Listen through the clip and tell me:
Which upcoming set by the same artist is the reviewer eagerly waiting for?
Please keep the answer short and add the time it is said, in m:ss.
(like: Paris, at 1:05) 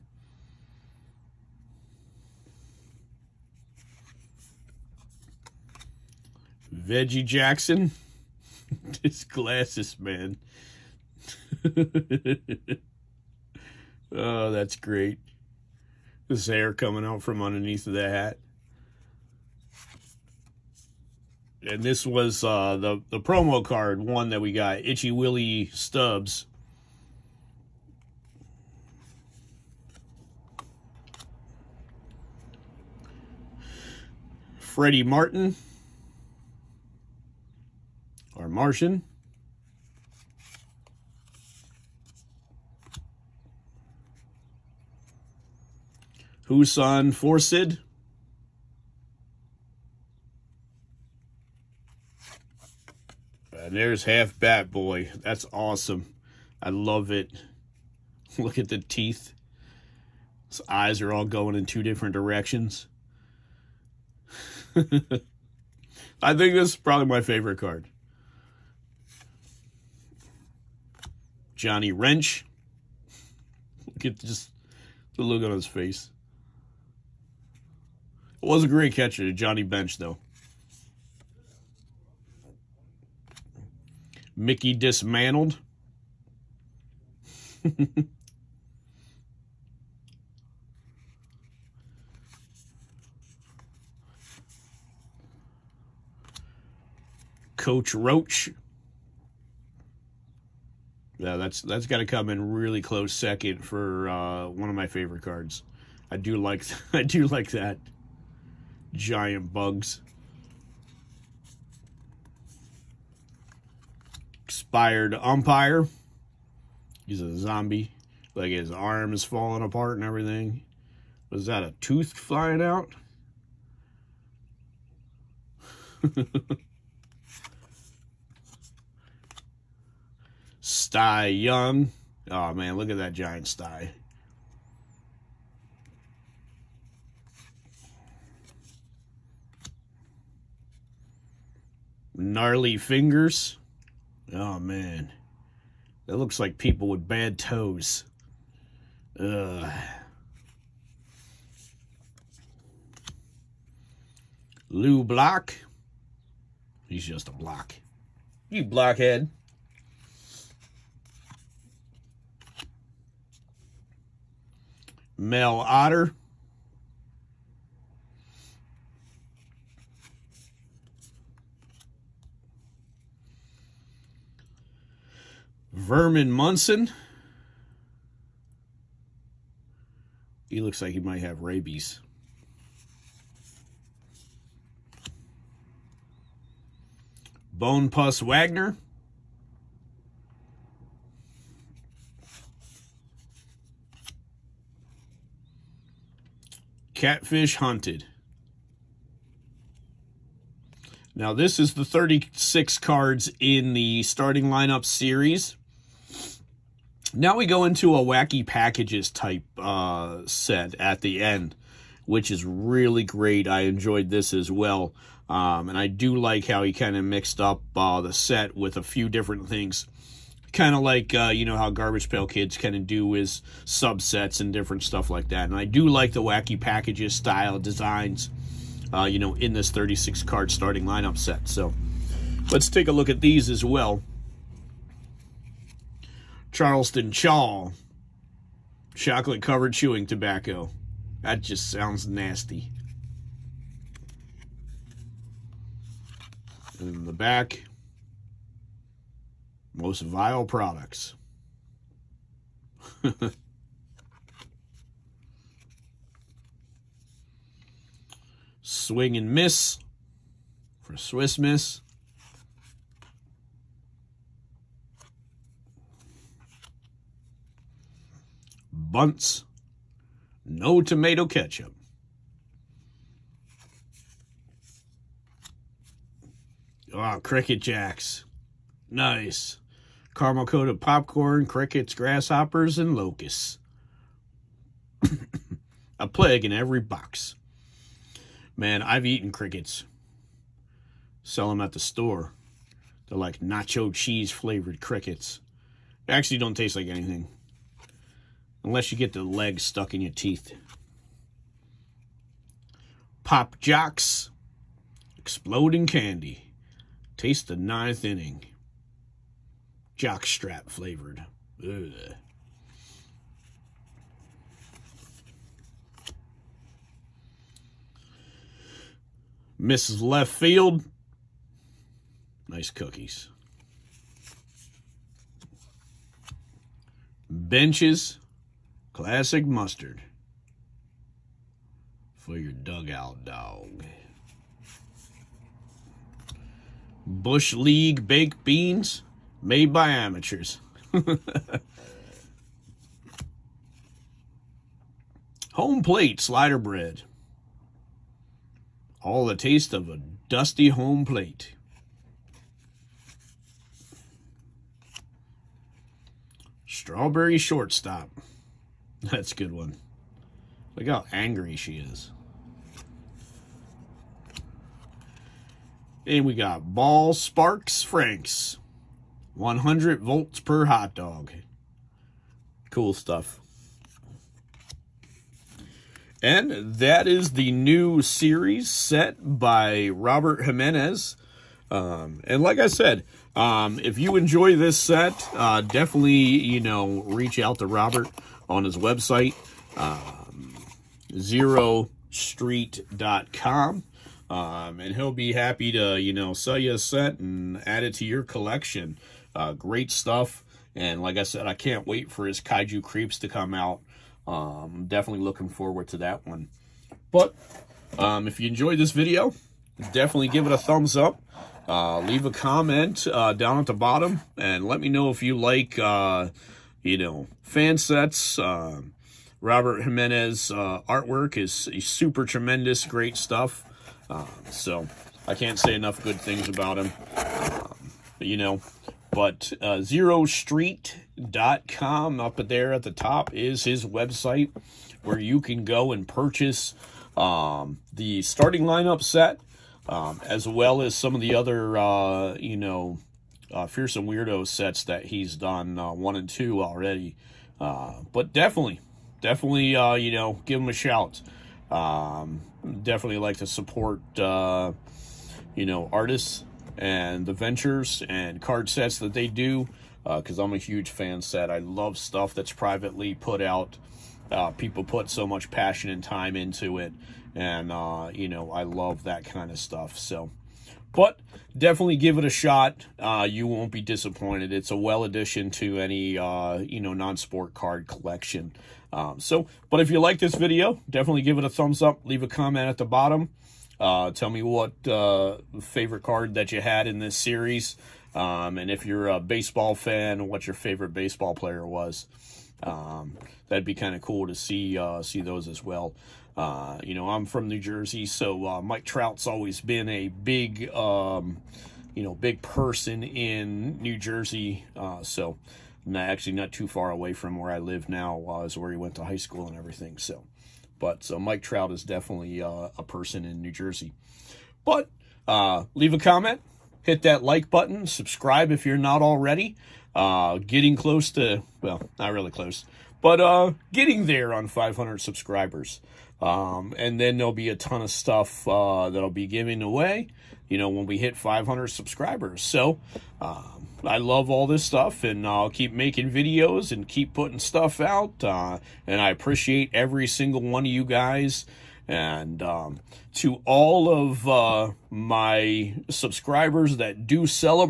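Kaiju Creeps, at 6:42.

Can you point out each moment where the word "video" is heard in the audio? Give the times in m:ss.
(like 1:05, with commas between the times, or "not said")
6:48, 8:00, 8:56.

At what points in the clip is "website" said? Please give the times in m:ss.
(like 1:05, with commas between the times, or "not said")
6:28, 7:13.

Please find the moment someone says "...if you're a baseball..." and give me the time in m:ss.
8:08.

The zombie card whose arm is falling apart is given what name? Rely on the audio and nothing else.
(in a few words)
Expired umpire.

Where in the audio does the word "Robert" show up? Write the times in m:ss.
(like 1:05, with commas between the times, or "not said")
6:19, 6:27, 6:59.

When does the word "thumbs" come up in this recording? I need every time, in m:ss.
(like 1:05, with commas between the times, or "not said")
6:50, 8:01.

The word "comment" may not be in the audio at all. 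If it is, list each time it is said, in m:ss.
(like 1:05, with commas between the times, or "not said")
6:52, 8:02, 8:35.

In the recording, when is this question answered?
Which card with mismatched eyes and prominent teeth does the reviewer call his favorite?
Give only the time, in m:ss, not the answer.
0:54.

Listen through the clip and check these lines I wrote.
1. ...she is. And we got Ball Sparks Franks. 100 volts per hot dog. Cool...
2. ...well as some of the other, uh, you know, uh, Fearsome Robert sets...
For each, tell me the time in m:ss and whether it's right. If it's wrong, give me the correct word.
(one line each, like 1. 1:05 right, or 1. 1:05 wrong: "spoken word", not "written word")
1. 6:01 right
2. 7:20 wrong: "Weirdo", not "Robert".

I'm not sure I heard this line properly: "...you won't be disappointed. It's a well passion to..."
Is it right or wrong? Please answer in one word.
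wrong.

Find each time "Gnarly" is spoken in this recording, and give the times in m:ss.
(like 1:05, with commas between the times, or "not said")
2:22.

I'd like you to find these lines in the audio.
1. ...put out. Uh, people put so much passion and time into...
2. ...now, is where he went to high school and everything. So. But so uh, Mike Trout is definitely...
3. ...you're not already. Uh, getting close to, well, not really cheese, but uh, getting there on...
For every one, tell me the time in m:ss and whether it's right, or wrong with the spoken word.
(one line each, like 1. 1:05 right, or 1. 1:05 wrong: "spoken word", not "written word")
1. 7:43 right
2. 8:27 right
3. 8:38 wrong: "close", not "cheese".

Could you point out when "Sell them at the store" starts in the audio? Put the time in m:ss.
4:51.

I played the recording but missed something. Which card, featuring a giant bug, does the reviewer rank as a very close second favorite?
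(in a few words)
Coach Roach.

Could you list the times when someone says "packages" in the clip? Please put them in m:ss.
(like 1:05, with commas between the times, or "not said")
3:28, 3:46.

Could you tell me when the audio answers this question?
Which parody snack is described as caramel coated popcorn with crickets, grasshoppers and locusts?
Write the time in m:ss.
4:37.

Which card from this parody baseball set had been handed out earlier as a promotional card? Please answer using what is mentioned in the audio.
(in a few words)
Itchy Willy Stubbs.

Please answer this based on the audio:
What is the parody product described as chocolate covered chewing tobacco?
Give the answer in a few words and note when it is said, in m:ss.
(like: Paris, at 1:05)
Charleston Chaw, at 3:56.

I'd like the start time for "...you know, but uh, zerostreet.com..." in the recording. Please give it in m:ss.
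7:08.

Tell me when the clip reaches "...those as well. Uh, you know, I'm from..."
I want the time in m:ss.
8:15.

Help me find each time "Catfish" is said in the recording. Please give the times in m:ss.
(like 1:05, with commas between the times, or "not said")
3:16.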